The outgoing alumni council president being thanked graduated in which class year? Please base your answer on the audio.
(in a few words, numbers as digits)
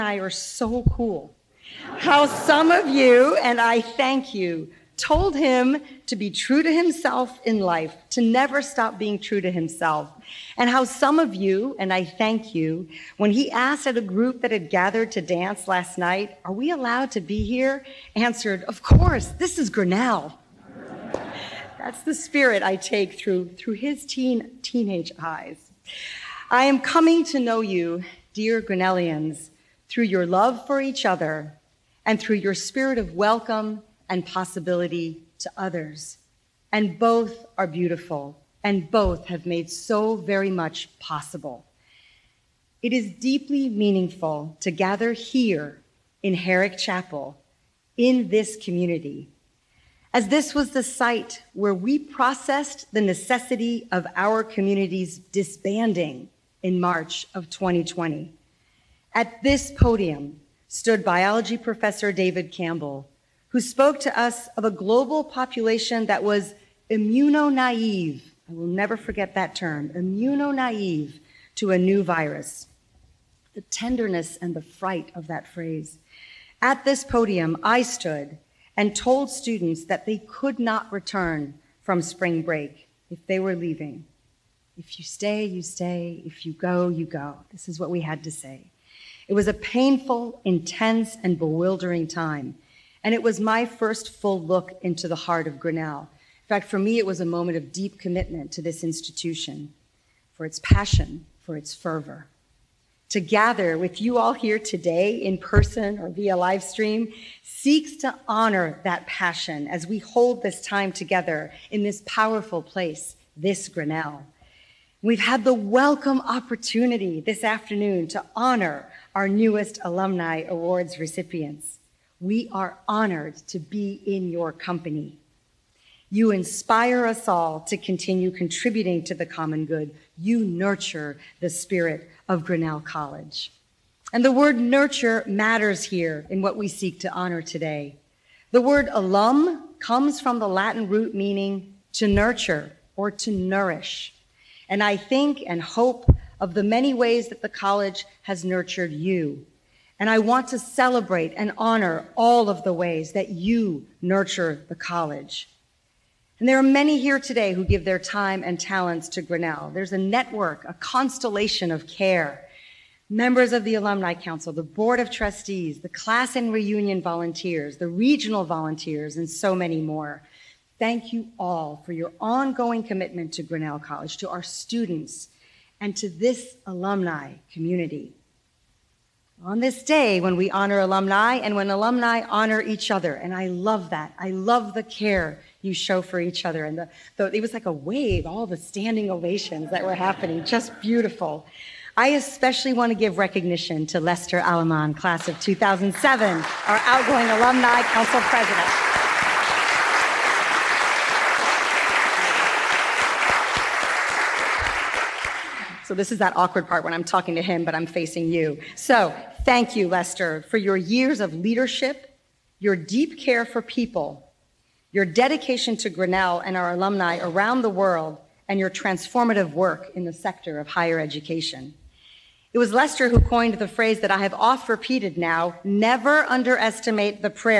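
2007.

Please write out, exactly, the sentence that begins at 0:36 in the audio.
And both are beautiful, and both have made so very much possible.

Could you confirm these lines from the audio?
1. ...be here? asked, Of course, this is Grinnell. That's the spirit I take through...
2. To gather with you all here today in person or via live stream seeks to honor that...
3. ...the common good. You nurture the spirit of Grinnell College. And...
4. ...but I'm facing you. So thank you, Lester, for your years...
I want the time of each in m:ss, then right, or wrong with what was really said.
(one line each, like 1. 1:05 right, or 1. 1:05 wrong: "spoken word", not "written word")
1. 0:17 wrong: "answered", not "asked"
2. 1:43 right
3. 2:09 right
4. 3:27 right.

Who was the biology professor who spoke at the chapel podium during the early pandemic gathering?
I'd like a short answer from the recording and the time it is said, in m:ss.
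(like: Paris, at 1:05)
David Campbell, at 1:02.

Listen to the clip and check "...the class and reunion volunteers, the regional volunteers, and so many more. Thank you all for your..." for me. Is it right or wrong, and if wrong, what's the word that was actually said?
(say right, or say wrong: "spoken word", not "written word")
right.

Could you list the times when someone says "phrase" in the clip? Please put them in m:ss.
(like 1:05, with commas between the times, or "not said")
1:15, 3:43.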